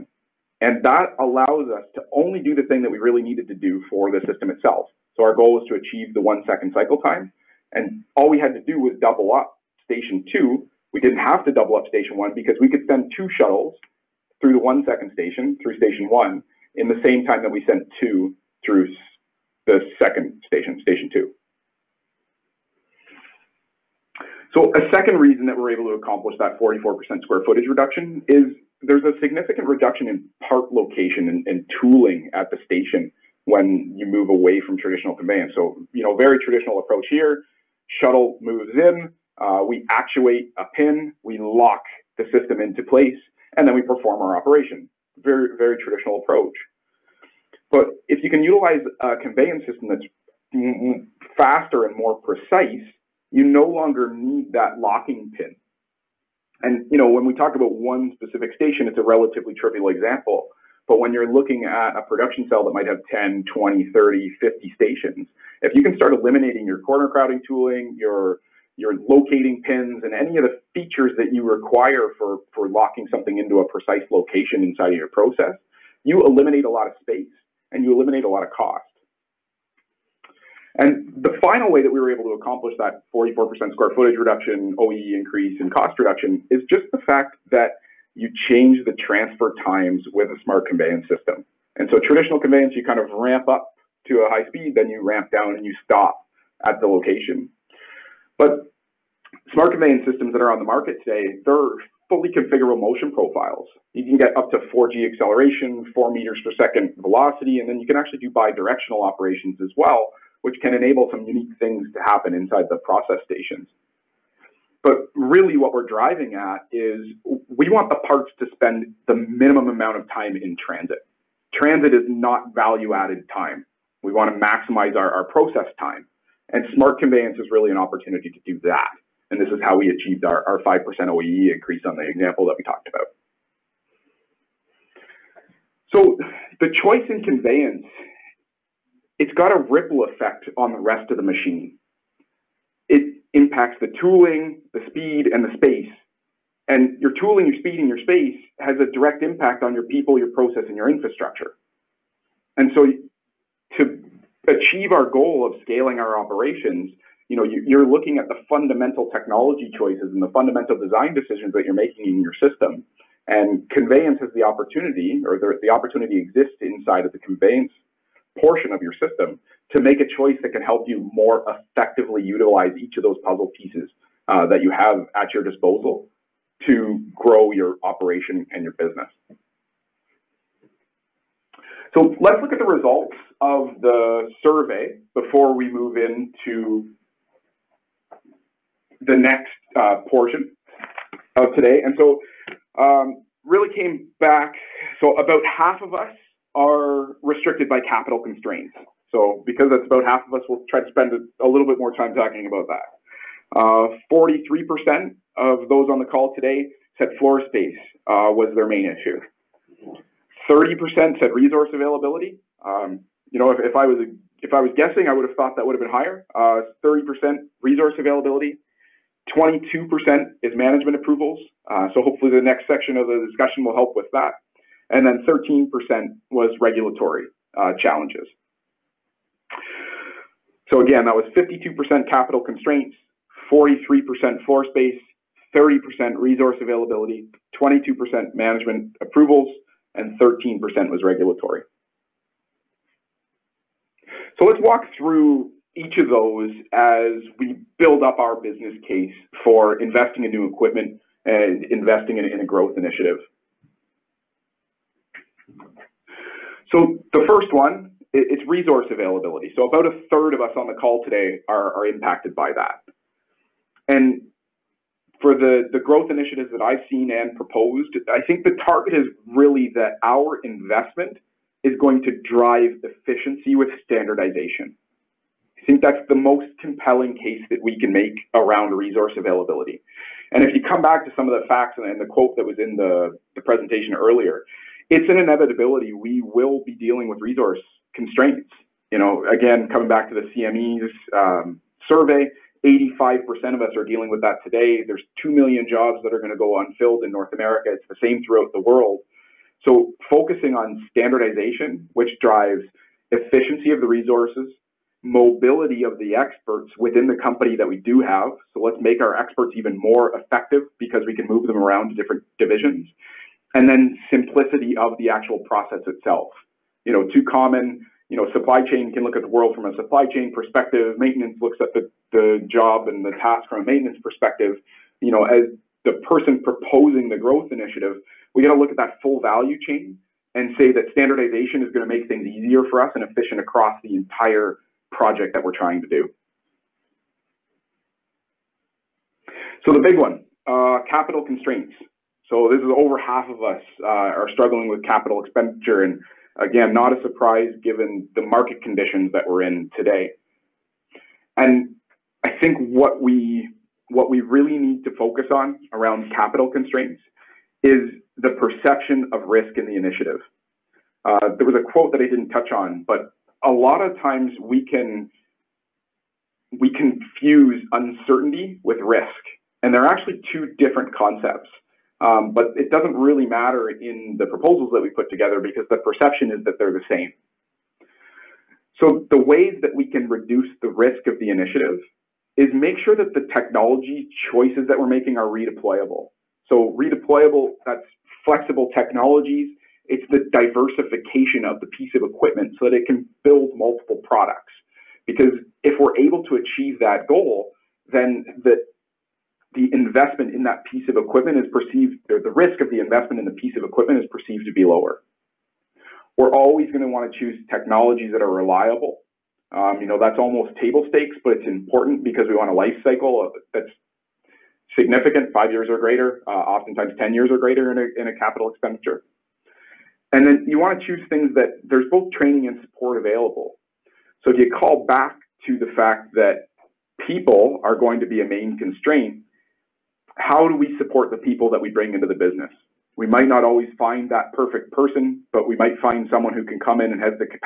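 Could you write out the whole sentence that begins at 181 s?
So let's look at the results of the survey before we move into the next uh, portion of today.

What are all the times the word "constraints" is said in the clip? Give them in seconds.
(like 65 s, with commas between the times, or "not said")
198 s, 232 s, 287 s, 341 s, 356 s, 428 s.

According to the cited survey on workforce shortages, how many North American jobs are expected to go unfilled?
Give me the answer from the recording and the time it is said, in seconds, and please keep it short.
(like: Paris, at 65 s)
2 million, at 295 s.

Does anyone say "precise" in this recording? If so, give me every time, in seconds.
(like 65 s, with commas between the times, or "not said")
52 s, 73 s.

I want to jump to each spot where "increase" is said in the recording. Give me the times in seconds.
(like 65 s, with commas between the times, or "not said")
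85 s, 131 s.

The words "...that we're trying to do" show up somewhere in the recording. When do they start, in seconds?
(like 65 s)
335 s.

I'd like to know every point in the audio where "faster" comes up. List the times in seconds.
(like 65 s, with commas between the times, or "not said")
51 s.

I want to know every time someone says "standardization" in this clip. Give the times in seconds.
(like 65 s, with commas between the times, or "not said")
273 s, 300 s, 330 s.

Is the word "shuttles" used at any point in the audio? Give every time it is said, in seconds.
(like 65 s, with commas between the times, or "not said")
13 s, 37 s.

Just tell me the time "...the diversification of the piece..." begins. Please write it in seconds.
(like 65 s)
390 s.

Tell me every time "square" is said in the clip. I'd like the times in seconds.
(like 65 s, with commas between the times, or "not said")
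27 s, 83 s.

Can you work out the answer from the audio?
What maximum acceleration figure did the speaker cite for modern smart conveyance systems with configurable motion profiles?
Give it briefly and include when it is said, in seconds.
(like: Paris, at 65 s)
4G, at 104 s.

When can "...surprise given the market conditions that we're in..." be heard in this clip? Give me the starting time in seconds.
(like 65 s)
347 s.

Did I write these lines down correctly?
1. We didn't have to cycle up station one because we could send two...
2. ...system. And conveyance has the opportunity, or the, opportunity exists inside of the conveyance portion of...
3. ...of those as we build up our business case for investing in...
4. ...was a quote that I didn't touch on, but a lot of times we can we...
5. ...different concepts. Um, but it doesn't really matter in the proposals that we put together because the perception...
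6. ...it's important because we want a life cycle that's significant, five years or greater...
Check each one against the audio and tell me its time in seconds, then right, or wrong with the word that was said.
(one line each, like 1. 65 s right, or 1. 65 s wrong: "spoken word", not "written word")
1. 10 s wrong: "double", not "cycle"
2. 162 s right
3. 245 s right
4. 361 s right
5. 370 s right
6. 411 s right.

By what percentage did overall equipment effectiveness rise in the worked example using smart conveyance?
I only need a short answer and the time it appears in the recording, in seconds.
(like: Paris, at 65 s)
5%, at 130 s.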